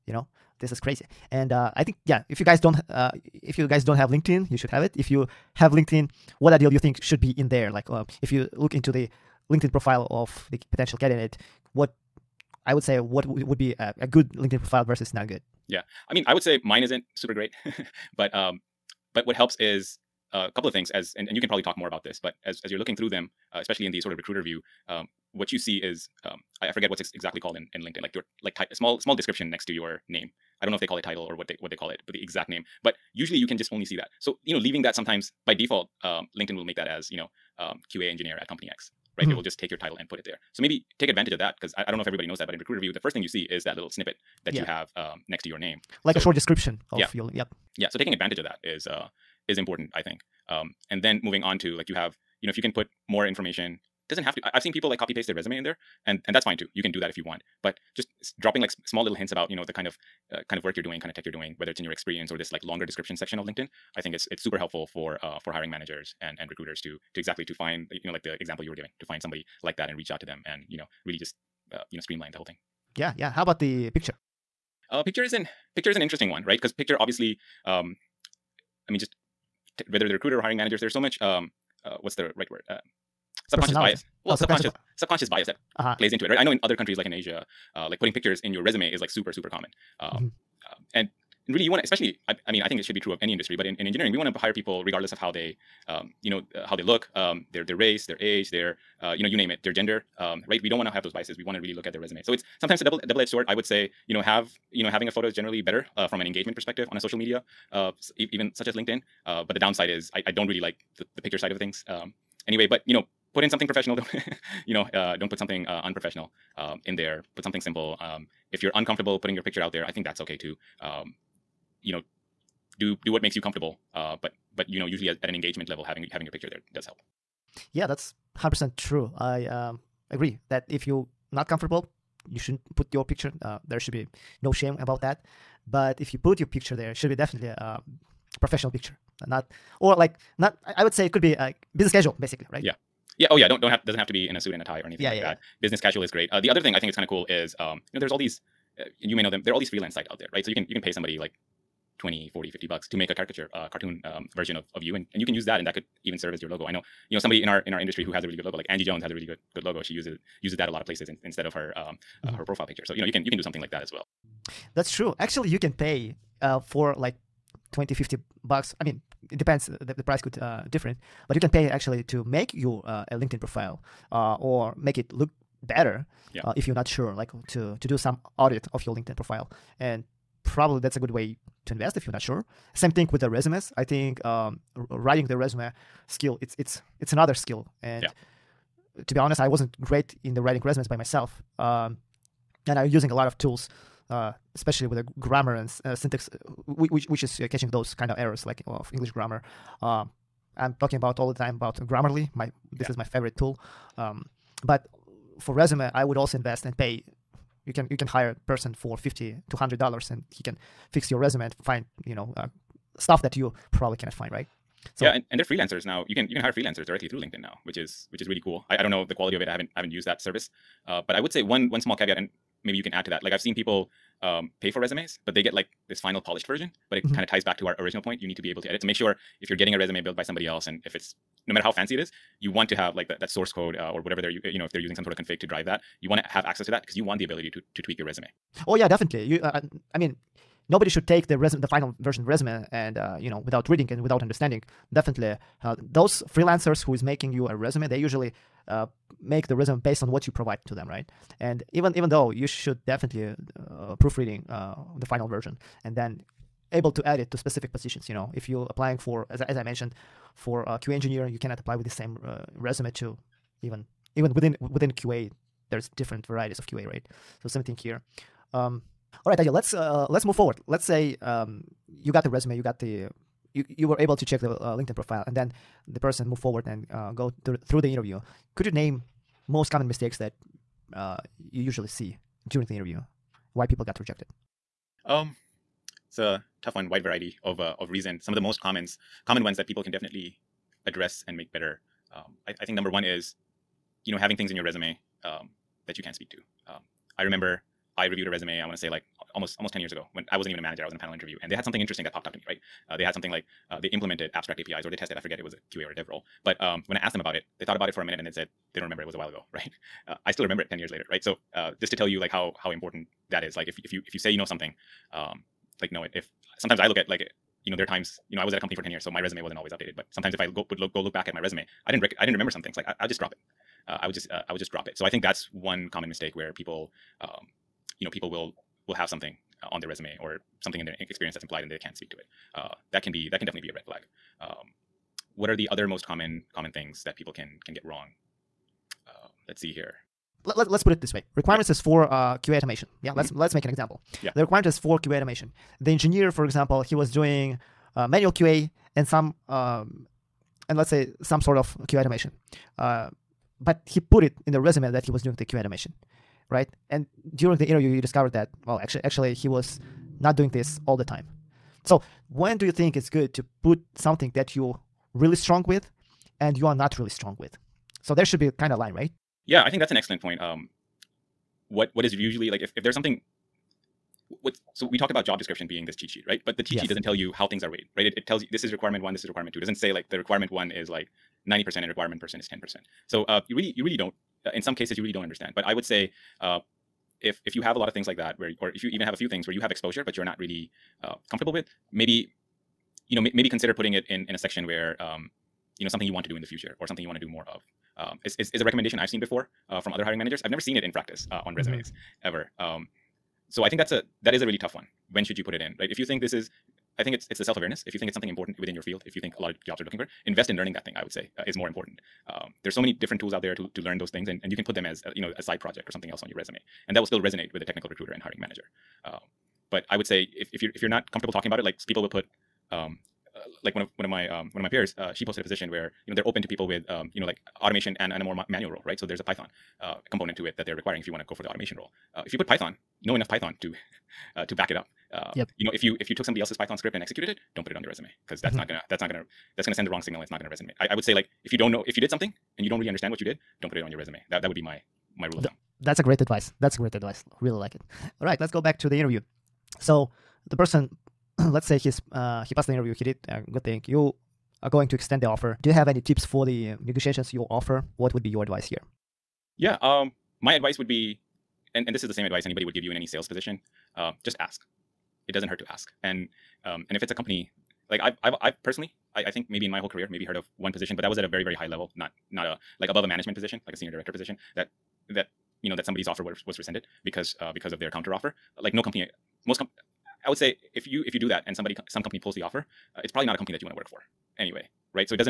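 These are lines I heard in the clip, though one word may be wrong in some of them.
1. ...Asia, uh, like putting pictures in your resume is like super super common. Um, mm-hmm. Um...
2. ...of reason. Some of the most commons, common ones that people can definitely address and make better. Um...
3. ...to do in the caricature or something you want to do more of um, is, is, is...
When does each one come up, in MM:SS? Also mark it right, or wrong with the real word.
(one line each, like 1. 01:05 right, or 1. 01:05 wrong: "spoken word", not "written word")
1. 01:27 right
2. 04:47 right
3. 06:36 wrong: "future", not "caricature".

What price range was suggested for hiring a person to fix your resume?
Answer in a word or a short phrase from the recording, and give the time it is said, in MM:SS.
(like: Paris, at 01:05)
$50 to $100, at 03:28.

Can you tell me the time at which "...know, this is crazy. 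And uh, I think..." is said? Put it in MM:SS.
00:00.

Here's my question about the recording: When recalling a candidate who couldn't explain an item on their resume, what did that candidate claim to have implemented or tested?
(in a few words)
abstract APIs.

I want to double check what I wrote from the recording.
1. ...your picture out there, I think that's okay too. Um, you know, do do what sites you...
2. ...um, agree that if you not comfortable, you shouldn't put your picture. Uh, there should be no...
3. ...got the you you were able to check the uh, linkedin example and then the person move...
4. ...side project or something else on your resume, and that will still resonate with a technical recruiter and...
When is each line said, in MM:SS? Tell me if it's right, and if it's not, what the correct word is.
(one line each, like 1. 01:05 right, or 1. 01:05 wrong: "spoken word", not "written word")
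1. 01:59 wrong: "makes", not "sites"
2. 02:09 right
3. 04:32 wrong: "profile", not "example"
4. 06:55 right.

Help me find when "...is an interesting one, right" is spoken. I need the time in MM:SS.
01:15.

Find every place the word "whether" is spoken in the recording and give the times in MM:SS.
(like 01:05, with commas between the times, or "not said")
01:01, 01:19.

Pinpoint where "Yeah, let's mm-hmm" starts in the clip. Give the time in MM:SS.
05:43.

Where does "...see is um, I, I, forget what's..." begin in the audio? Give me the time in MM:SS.
00:25.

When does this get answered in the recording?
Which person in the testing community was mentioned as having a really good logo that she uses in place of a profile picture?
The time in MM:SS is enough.
02:38.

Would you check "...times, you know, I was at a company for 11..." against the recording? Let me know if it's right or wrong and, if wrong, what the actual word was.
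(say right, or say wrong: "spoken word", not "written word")
wrong: "10", not "11".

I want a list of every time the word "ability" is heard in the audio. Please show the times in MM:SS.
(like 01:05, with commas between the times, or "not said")
03:57.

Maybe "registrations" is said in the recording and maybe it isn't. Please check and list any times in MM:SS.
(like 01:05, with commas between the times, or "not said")
not said.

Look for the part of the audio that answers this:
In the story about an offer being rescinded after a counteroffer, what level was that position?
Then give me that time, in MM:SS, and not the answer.
07:53.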